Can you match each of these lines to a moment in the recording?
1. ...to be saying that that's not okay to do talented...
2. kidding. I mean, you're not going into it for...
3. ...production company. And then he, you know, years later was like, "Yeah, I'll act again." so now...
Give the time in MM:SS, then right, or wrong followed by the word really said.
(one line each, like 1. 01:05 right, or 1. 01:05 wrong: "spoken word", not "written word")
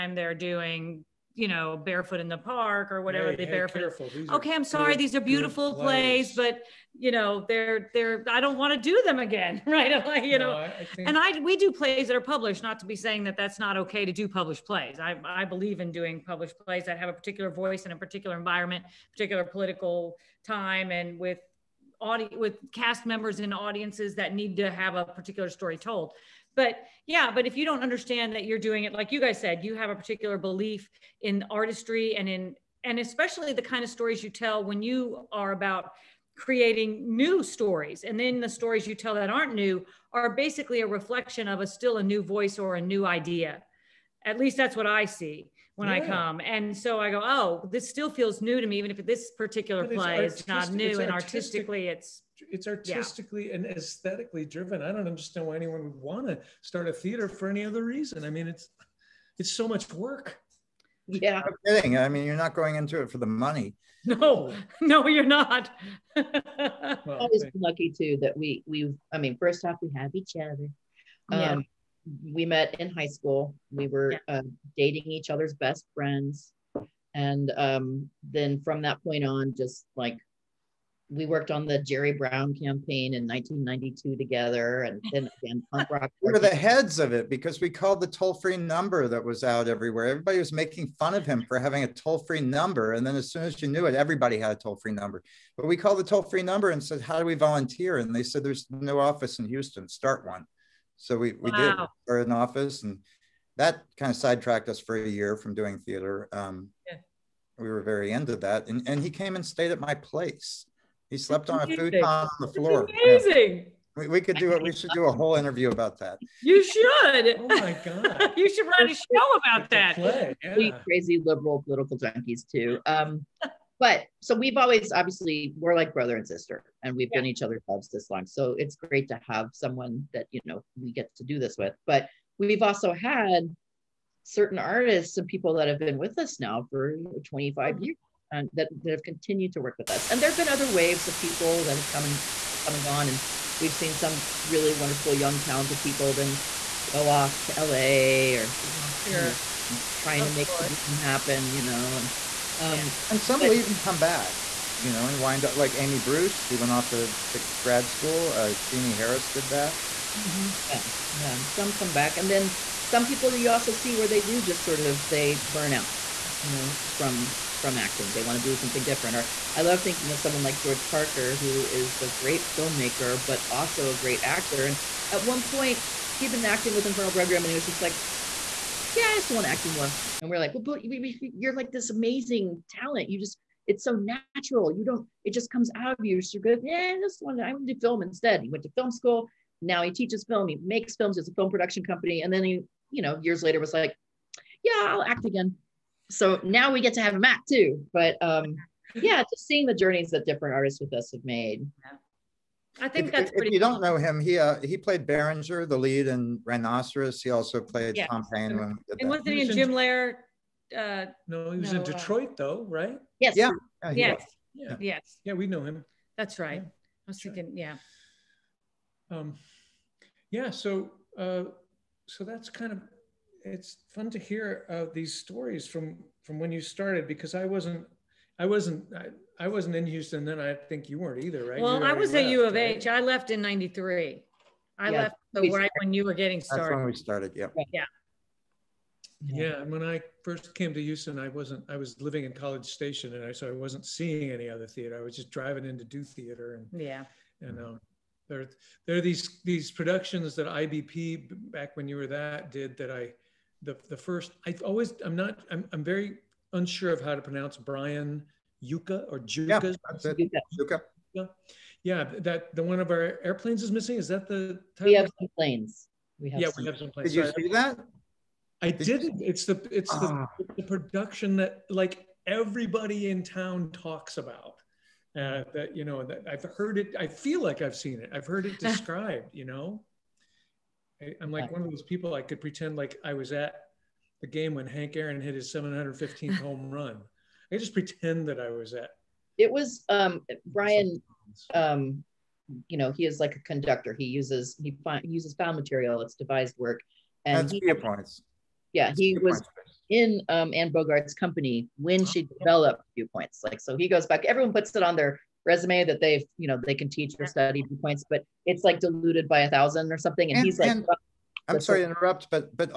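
1. 00:12 wrong: "published", not "talented"
2. 01:01 right
3. 03:11 right.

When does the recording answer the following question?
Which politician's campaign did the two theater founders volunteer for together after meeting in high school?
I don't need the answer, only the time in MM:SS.
01:21.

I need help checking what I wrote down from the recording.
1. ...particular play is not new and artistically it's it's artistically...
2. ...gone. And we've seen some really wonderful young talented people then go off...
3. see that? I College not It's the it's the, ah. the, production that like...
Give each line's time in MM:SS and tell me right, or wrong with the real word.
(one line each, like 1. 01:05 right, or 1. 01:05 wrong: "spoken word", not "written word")
1. 00:49 right
2. 02:22 right
3. 04:27 wrong: "Did", not "College".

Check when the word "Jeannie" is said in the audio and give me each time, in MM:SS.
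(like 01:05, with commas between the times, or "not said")
02:38.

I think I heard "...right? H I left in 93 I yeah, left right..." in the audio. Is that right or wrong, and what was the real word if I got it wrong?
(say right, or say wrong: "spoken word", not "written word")
right.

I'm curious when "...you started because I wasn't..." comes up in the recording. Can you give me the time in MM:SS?
03:46.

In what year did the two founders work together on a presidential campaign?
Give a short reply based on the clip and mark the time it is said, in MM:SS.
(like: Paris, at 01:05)
1992, at 01:23.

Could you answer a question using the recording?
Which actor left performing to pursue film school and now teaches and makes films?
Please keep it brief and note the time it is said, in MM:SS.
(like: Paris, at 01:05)
George Parker, at 02:50.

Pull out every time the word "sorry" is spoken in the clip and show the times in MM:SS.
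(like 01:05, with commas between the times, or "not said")
00:04, 04:27, 05:11.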